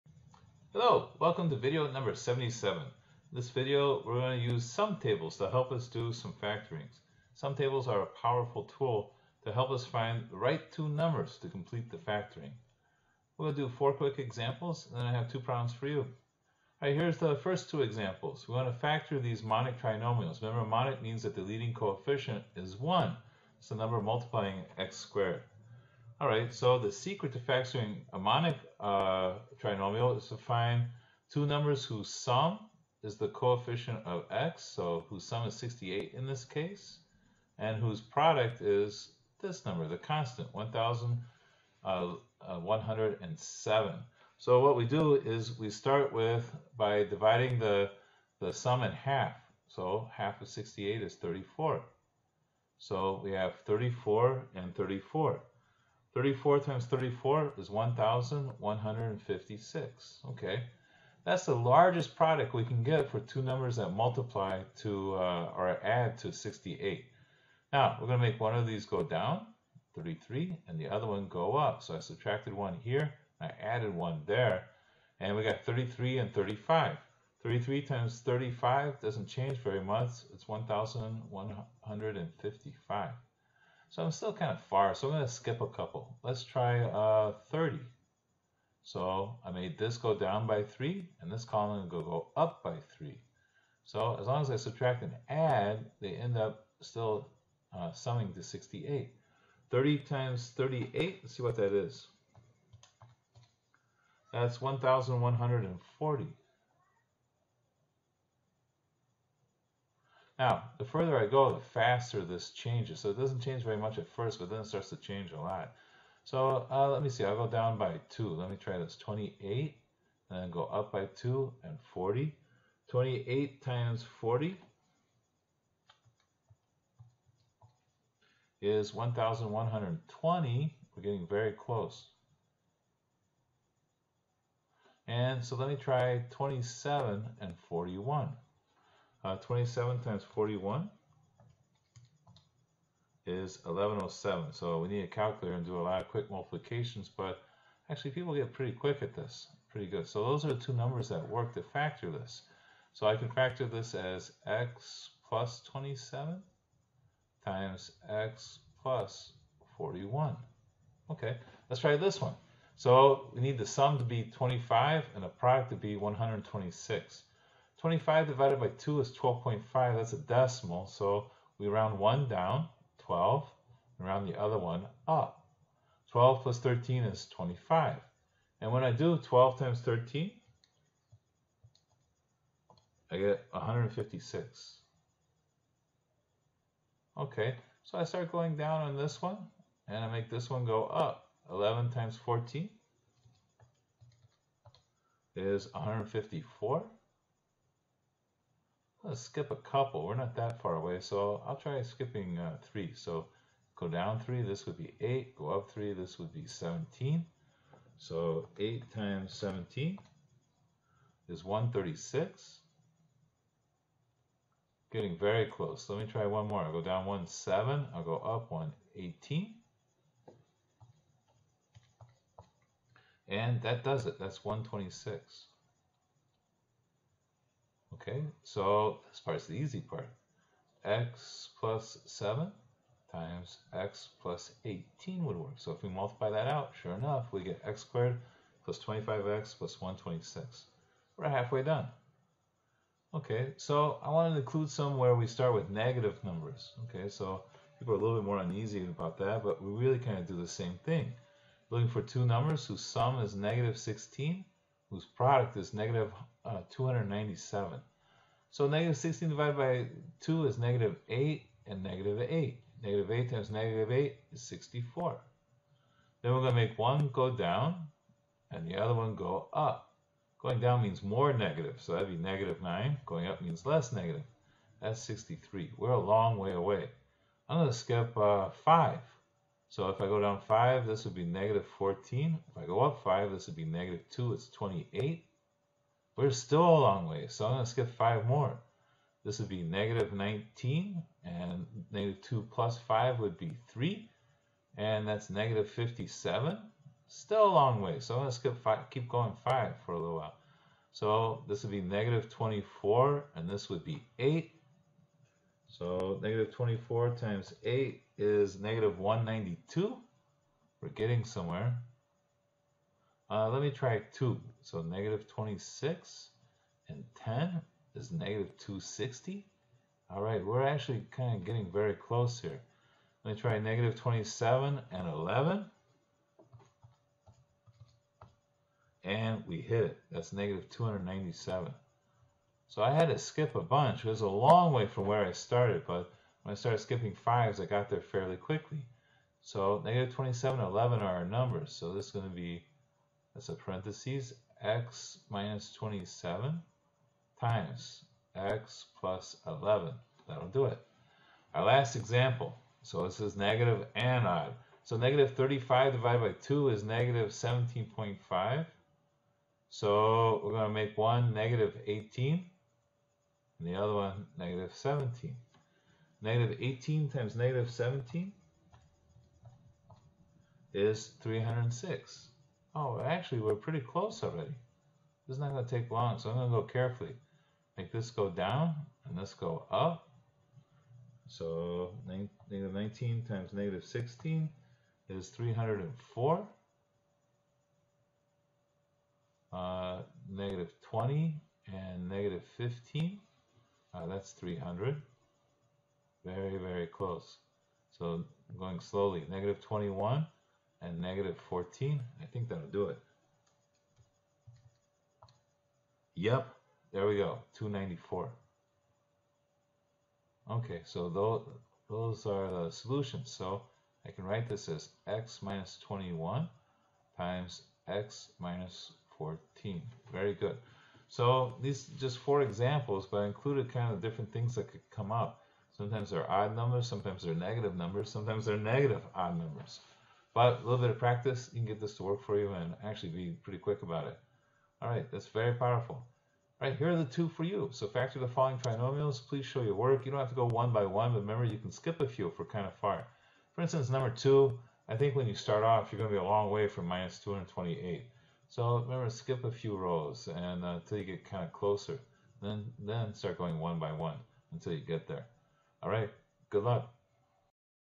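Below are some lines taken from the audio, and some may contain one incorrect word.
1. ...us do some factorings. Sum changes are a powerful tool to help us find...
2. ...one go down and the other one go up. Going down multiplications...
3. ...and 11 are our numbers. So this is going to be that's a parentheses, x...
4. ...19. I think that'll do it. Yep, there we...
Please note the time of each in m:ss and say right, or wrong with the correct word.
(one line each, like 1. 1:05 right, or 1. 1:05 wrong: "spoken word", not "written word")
1. 0:05 wrong: "tables", not "changes"
2. 4:26 wrong: "means", not "multiplications"
3. 5:40 right
4. 6:41 wrong: "14", not "19".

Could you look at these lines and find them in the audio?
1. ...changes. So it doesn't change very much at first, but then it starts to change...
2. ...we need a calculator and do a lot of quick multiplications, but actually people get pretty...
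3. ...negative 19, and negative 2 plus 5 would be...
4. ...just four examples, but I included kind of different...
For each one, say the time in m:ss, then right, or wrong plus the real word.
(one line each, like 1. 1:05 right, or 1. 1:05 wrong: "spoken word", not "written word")
1. 1:52 right
2. 2:24 right
3. 4:49 right
4. 7:01 right.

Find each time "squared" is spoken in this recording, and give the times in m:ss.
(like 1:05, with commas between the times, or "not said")
0:24, 3:57.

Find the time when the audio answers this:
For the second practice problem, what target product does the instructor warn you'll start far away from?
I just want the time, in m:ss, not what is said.
7:26.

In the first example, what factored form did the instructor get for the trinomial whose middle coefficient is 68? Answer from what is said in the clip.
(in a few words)
x plus 27 times x plus 41.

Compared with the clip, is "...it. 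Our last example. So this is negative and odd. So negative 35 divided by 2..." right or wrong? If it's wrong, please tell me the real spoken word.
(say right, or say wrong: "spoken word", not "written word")
right.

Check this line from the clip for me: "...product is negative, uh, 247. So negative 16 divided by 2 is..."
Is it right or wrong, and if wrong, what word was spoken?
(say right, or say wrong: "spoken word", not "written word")
wrong: "297", not "247".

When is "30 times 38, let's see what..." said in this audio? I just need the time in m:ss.
1:39.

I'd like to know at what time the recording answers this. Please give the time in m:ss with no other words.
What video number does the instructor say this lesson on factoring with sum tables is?
0:02.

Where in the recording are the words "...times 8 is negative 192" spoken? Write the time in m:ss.
5:07.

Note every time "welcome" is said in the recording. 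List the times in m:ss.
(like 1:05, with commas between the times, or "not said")
0:01.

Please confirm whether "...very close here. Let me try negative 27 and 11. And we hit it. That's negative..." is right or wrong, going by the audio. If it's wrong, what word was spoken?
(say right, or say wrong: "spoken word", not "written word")
right.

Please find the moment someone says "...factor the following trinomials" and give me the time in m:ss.
7:17.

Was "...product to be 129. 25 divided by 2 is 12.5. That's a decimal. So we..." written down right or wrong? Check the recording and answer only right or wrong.
wrong.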